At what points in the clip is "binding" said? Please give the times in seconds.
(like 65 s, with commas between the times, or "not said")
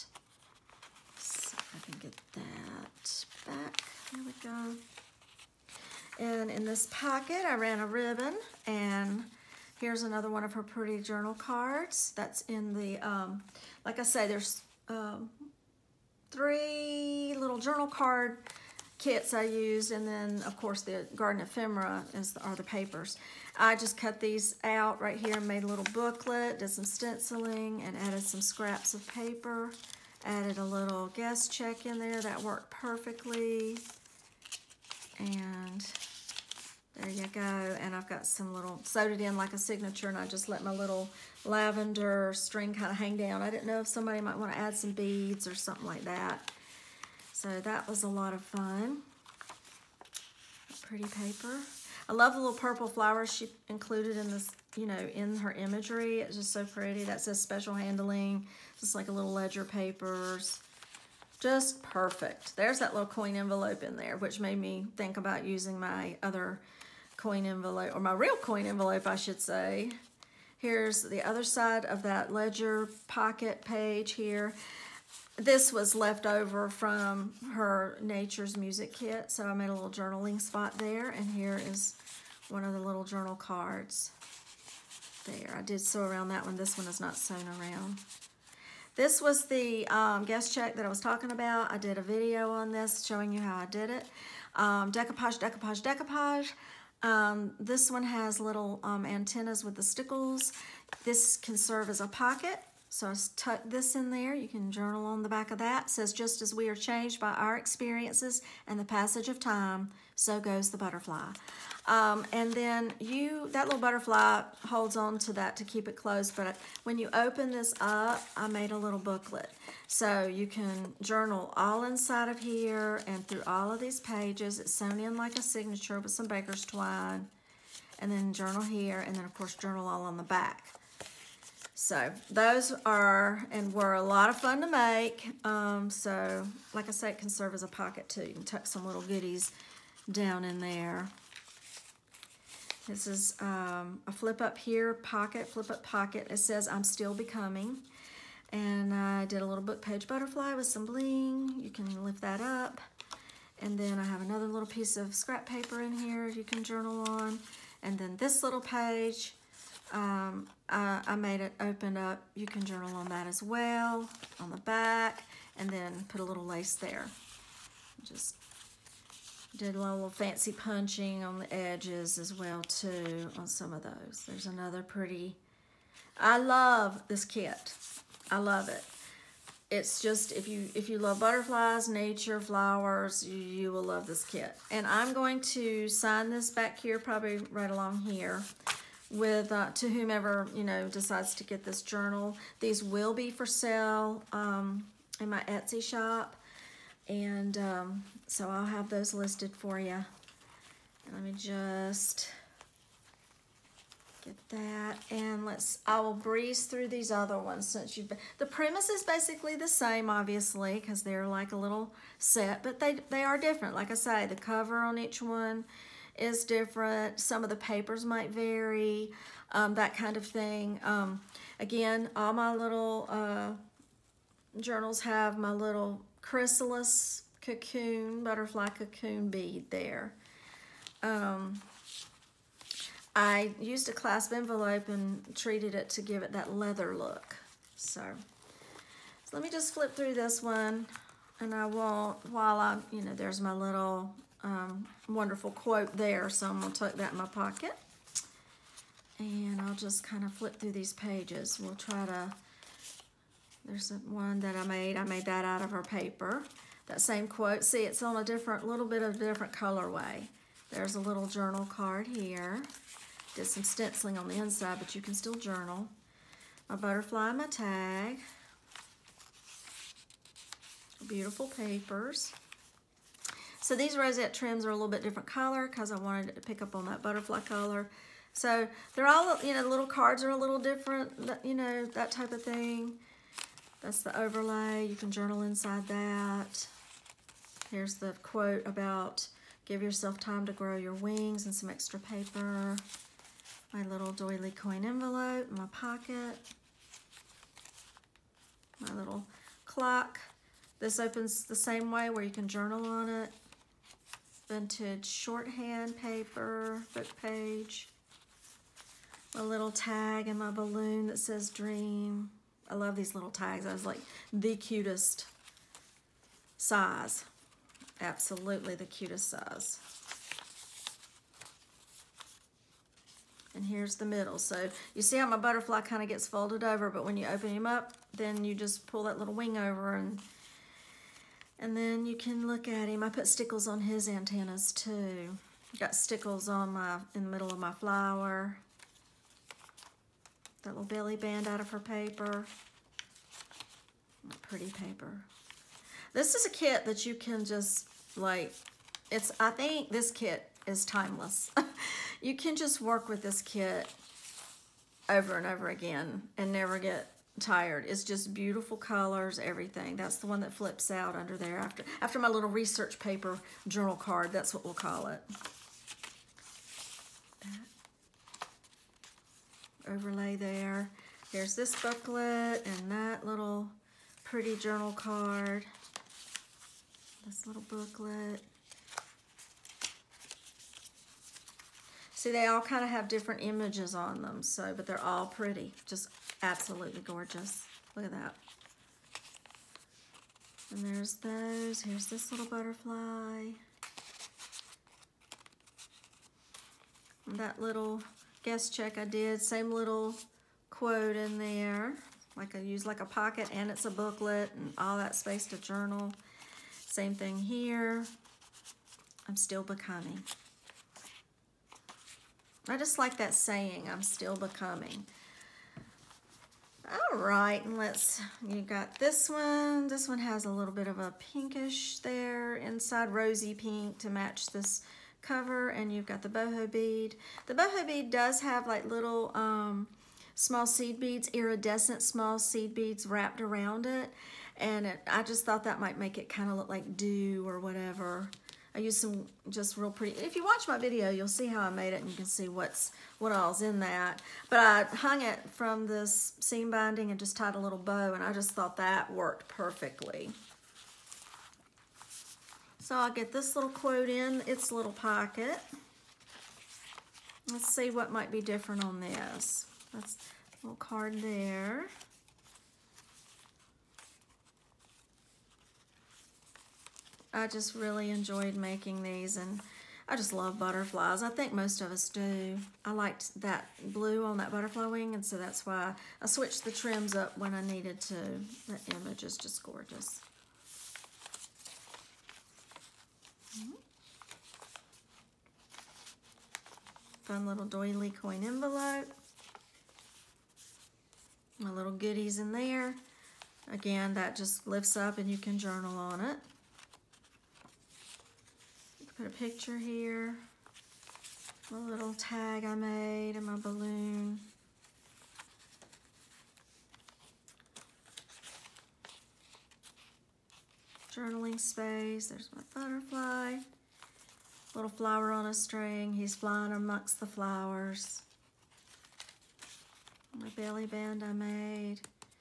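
446 s.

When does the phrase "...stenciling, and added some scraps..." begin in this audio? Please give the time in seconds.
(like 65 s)
26 s.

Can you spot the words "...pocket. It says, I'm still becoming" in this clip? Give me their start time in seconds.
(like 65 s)
145 s.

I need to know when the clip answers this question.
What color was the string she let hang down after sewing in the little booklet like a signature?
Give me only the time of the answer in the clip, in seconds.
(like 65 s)
41 s.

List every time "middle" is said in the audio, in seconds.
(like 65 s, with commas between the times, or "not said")
324 s, 337 s.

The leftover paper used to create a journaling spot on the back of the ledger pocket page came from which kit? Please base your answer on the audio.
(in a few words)
Nature's Music Kit.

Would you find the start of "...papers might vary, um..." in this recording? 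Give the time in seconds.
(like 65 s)
217 s.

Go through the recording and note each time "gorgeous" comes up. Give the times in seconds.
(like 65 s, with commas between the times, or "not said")
387 s, 479 s.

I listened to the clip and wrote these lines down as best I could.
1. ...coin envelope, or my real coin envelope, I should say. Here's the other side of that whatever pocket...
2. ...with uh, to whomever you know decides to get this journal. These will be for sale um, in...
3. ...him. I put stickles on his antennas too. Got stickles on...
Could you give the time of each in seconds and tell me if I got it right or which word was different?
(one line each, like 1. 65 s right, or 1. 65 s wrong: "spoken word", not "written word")
1. 67 s wrong: "ledger", not "whatever"
2. 189 s right
3. 332 s right.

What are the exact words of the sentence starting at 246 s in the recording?
So I'm gonna tuck that in my pocket and I'll just kind of flip through these pages.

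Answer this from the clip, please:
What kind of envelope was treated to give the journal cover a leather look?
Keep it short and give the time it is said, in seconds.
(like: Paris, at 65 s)
Clasp envelope, at 233 s.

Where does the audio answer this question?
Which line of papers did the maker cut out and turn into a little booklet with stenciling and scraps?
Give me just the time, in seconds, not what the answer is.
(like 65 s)
21 s.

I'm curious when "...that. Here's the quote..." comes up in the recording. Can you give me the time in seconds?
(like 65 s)
285 s.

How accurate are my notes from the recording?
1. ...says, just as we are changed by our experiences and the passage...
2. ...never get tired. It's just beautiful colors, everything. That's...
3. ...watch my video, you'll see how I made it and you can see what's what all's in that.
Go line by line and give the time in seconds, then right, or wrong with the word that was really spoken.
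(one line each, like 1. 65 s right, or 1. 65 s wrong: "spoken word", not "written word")
1. 105 s right
2. 356 s right
3. 440 s right.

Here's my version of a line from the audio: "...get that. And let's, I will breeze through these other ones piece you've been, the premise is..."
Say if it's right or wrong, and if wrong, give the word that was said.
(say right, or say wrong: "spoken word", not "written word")
wrong: "since", not "piece".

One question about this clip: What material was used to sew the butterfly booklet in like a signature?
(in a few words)
Baker's twine.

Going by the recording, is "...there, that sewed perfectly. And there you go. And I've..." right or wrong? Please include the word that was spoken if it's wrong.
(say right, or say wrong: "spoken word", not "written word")
wrong: "worked", not "sewed".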